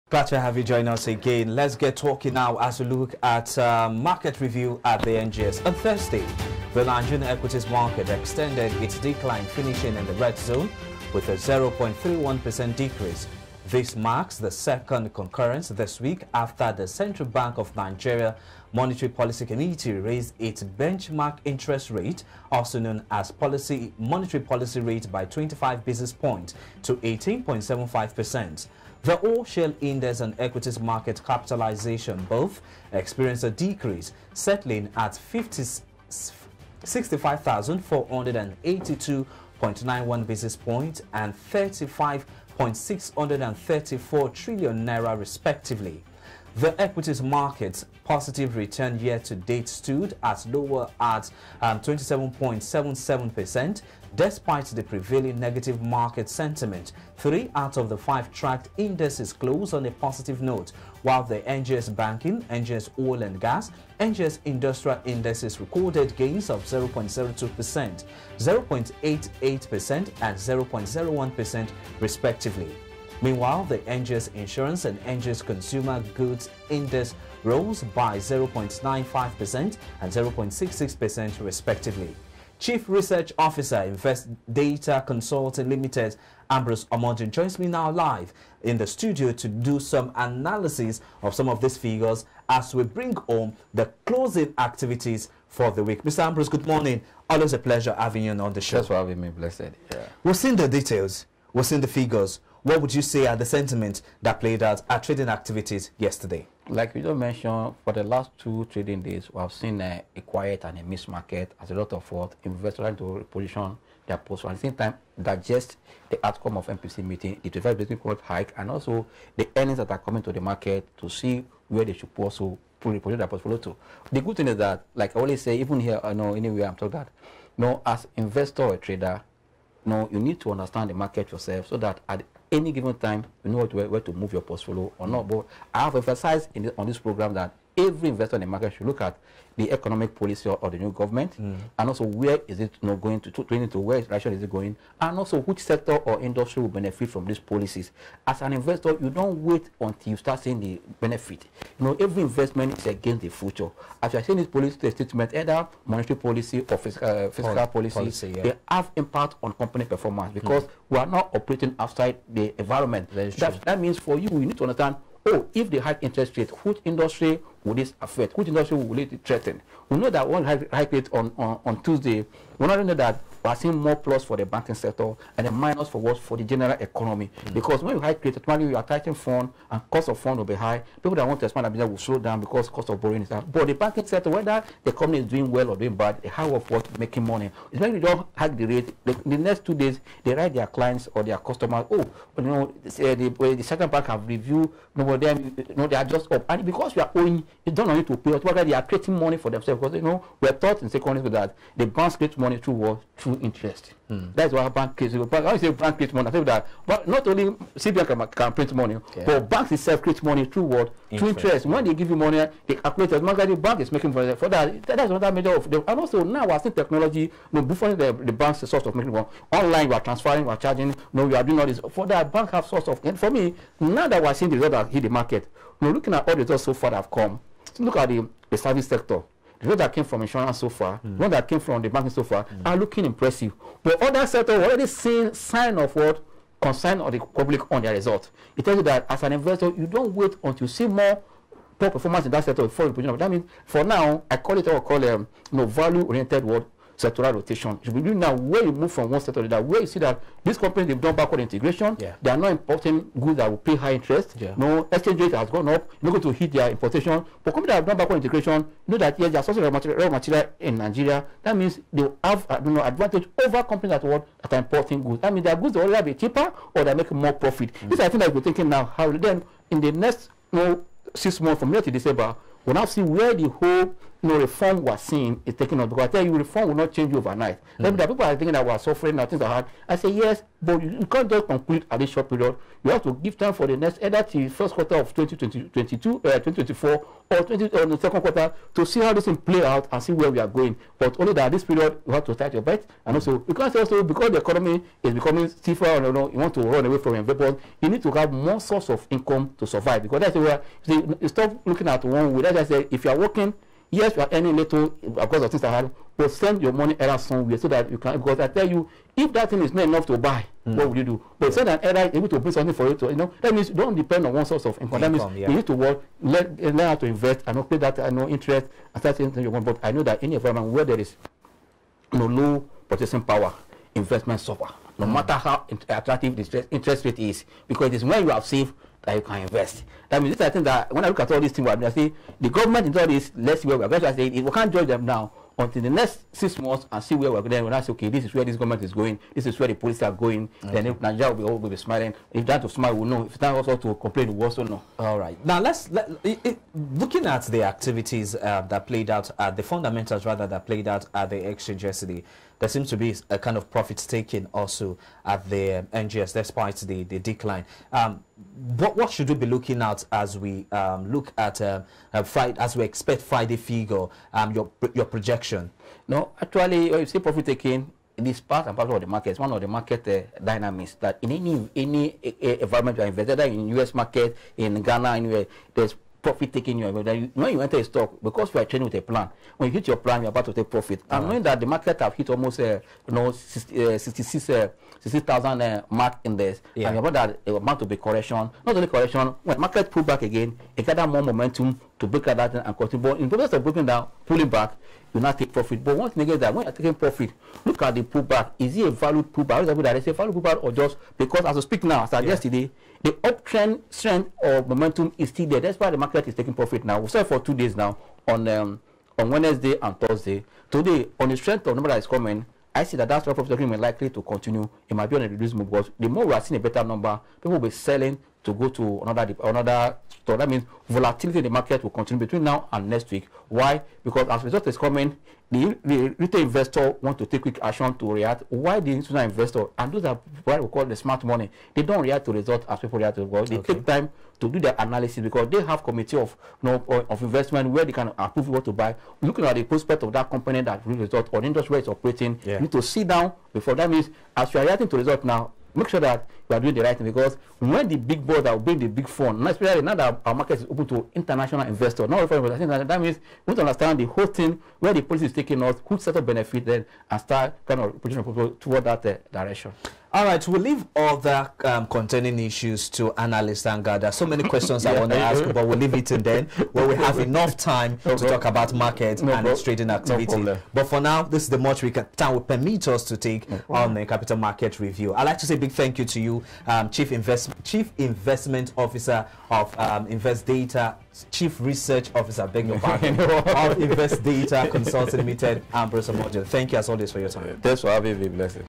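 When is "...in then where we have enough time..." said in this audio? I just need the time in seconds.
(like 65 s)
466 s.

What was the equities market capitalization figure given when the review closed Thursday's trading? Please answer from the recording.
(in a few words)
35.634 trillion naira.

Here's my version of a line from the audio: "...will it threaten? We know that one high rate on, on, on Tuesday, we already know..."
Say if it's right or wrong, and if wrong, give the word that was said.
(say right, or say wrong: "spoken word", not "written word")
right.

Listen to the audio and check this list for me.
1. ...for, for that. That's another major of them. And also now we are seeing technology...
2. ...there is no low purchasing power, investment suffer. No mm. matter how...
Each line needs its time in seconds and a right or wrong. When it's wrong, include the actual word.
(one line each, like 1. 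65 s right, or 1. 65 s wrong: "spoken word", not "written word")
1. 214 s right
2. 320 s right.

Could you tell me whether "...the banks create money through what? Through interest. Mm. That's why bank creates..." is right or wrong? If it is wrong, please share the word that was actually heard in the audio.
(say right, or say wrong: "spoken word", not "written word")
right.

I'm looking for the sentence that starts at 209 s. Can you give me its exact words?
but banks itself create money through what?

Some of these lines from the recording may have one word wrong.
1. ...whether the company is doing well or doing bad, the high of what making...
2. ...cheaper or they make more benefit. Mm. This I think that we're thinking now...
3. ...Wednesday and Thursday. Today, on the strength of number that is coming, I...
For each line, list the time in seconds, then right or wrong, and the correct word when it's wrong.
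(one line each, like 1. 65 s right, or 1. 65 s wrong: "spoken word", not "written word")
1. 184 s right
2. 266 s wrong: "profit", not "benefit"
3. 409 s right.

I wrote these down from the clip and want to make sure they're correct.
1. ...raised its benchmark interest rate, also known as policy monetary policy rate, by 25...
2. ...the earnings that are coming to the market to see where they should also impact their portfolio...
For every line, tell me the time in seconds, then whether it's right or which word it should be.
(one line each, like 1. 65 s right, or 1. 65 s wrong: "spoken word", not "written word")
1. 19 s right
2. 119 s wrong: "project", not "impact".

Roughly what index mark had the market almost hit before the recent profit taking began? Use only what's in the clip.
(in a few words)
66,000.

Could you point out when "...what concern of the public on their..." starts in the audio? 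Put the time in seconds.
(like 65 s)
235 s.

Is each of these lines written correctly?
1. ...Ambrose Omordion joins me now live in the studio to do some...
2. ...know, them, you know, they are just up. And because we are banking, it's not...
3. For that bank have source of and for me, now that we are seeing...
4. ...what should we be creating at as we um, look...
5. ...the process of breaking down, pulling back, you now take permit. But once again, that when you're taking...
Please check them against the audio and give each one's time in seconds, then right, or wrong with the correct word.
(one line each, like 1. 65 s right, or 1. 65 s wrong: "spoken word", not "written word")
1. 86 s right
2. 195 s wrong: "owing", not "banking"
3. 221 s right
4. 358 s wrong: "looking", not "creating"
5. 393 s wrong: "profit", not "permit".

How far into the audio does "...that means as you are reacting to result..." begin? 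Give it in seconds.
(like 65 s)
443 s.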